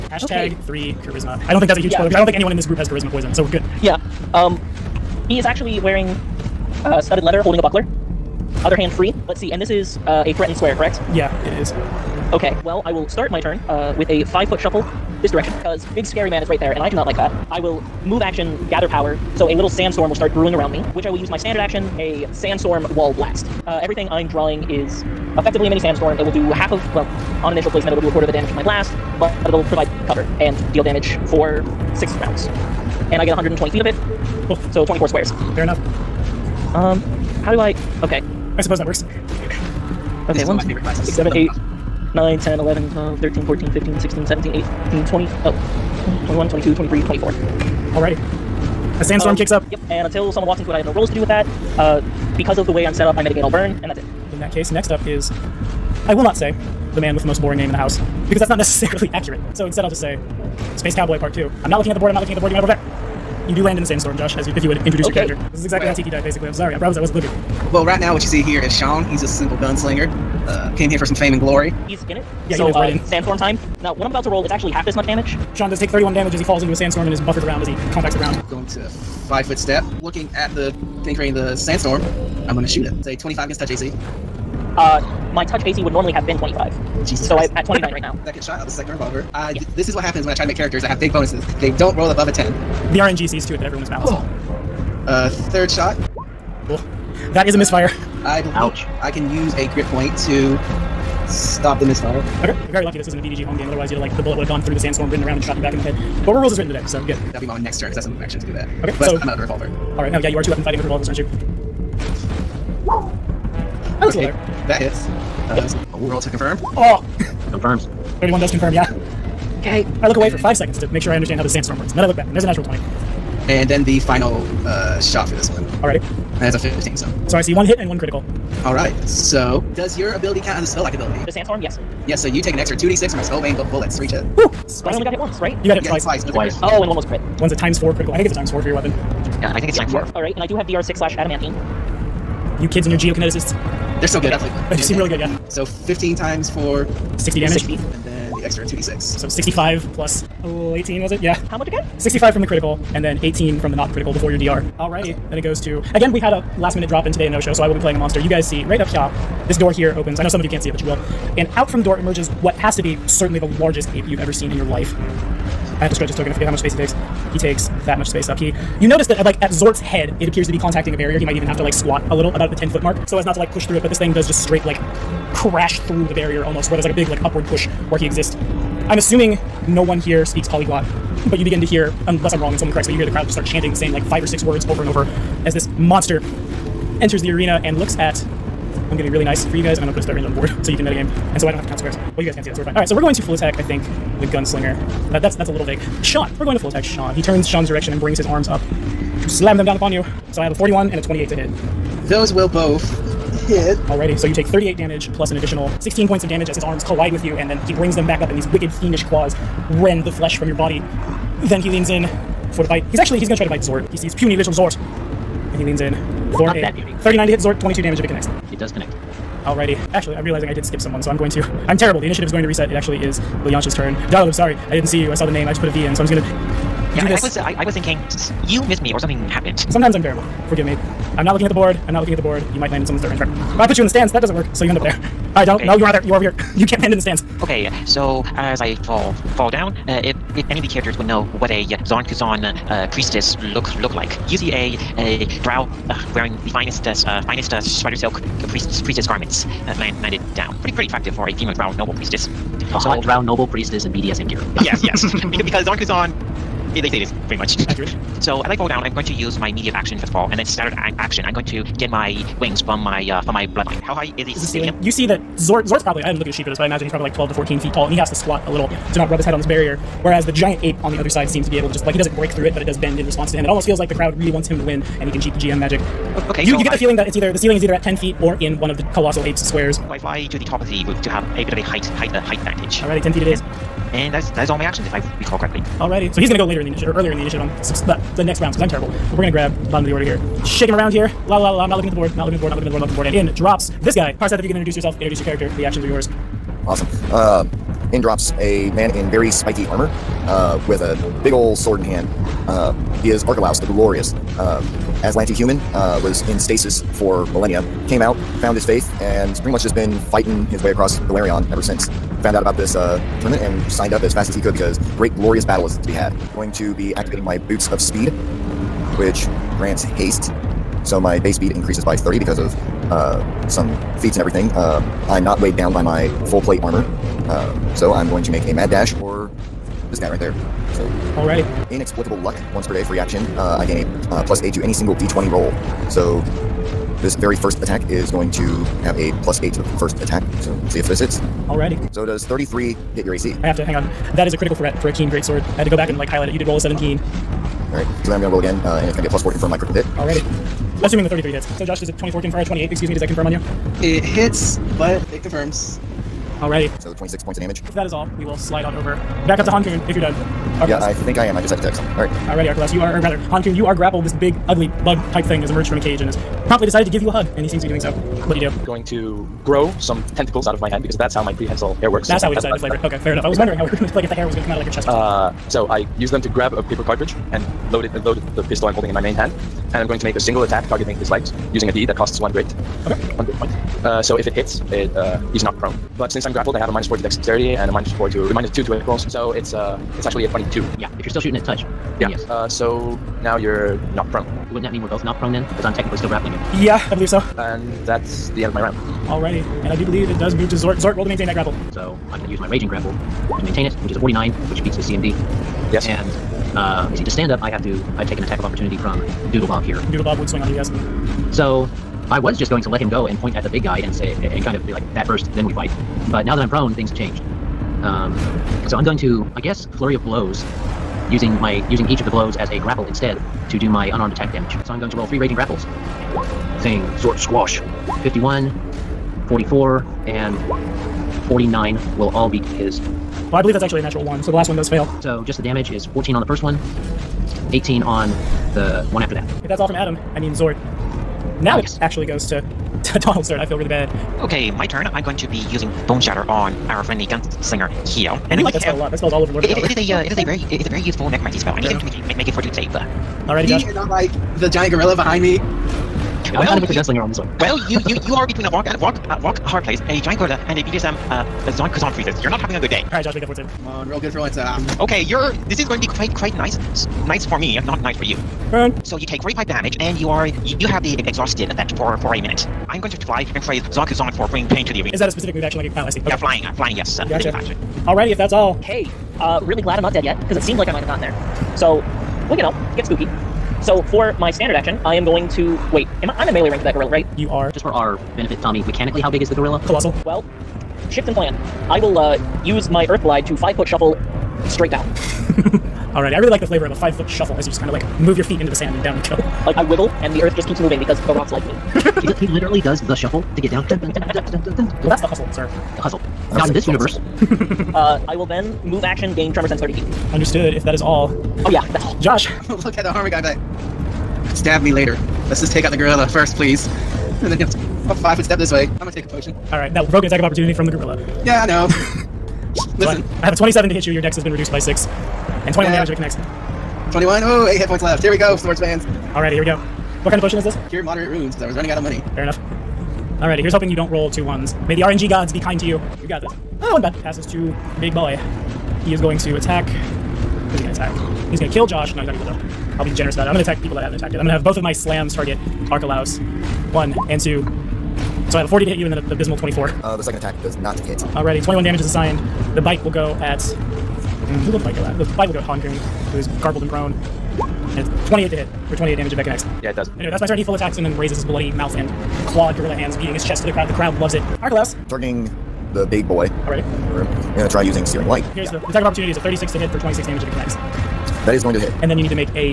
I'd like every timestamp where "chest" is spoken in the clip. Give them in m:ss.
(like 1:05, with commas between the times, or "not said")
6:14, 9:23.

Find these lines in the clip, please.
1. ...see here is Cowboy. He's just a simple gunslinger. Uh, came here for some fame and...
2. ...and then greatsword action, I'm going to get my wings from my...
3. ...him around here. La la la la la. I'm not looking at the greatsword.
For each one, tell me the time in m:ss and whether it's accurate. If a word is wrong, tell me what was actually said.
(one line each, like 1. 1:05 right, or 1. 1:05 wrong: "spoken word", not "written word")
1. 1:08 wrong: "Sean", not "Cowboy"
2. 4:20 wrong: "standard", not "greatsword"
3. 4:50 wrong: "board", not "greatsword".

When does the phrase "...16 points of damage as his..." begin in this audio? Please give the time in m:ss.
3:25.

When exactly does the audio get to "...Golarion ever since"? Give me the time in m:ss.
5:11.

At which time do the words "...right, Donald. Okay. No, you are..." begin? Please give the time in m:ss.
3:55.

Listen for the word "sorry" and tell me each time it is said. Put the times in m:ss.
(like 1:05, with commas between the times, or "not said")
1:06, 3:44.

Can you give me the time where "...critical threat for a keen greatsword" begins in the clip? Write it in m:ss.
5:44.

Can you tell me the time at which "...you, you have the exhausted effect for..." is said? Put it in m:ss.
7:50.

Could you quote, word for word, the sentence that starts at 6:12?
That's how we decided to flavor it.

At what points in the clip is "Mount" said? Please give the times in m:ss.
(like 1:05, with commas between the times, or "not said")
not said.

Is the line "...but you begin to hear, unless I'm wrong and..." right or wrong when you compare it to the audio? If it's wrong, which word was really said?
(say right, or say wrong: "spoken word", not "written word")
right.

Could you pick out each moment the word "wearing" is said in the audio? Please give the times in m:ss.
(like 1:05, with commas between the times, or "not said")
0:05, 4:06.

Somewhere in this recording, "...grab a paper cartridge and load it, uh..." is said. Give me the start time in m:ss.
6:16.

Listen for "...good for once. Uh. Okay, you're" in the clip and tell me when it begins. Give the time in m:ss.
7:43.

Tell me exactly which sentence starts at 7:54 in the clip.
Is that a specific move action?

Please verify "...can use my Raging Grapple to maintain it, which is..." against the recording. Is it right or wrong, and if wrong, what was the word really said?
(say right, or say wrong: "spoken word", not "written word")
right.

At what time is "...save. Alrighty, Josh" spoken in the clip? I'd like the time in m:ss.
7:32.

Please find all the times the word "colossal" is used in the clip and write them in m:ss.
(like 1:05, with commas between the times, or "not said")
4:38, 8:09.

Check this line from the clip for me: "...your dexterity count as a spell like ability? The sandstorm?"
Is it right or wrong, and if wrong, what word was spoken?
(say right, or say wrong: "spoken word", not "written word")
wrong: "ability", not "dexterity".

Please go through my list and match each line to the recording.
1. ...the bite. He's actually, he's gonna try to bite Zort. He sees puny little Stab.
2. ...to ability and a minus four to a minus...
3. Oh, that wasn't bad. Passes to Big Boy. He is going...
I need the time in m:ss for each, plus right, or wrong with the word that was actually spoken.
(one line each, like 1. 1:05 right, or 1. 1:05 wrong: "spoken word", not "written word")
1. 3:32 wrong: "Zort", not "Stab"
2. 6:26 wrong: "dexterity", not "ability"
3. 8:56 right.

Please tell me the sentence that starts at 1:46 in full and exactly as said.
But we're rules is written today, so good.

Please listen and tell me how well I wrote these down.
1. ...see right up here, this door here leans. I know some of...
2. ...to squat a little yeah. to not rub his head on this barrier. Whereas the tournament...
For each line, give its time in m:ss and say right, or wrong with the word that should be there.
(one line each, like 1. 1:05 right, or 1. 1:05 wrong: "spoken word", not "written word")
1. 2:38 wrong: "opens", not "leans"
2. 4:28 wrong: "giant", not "tournament".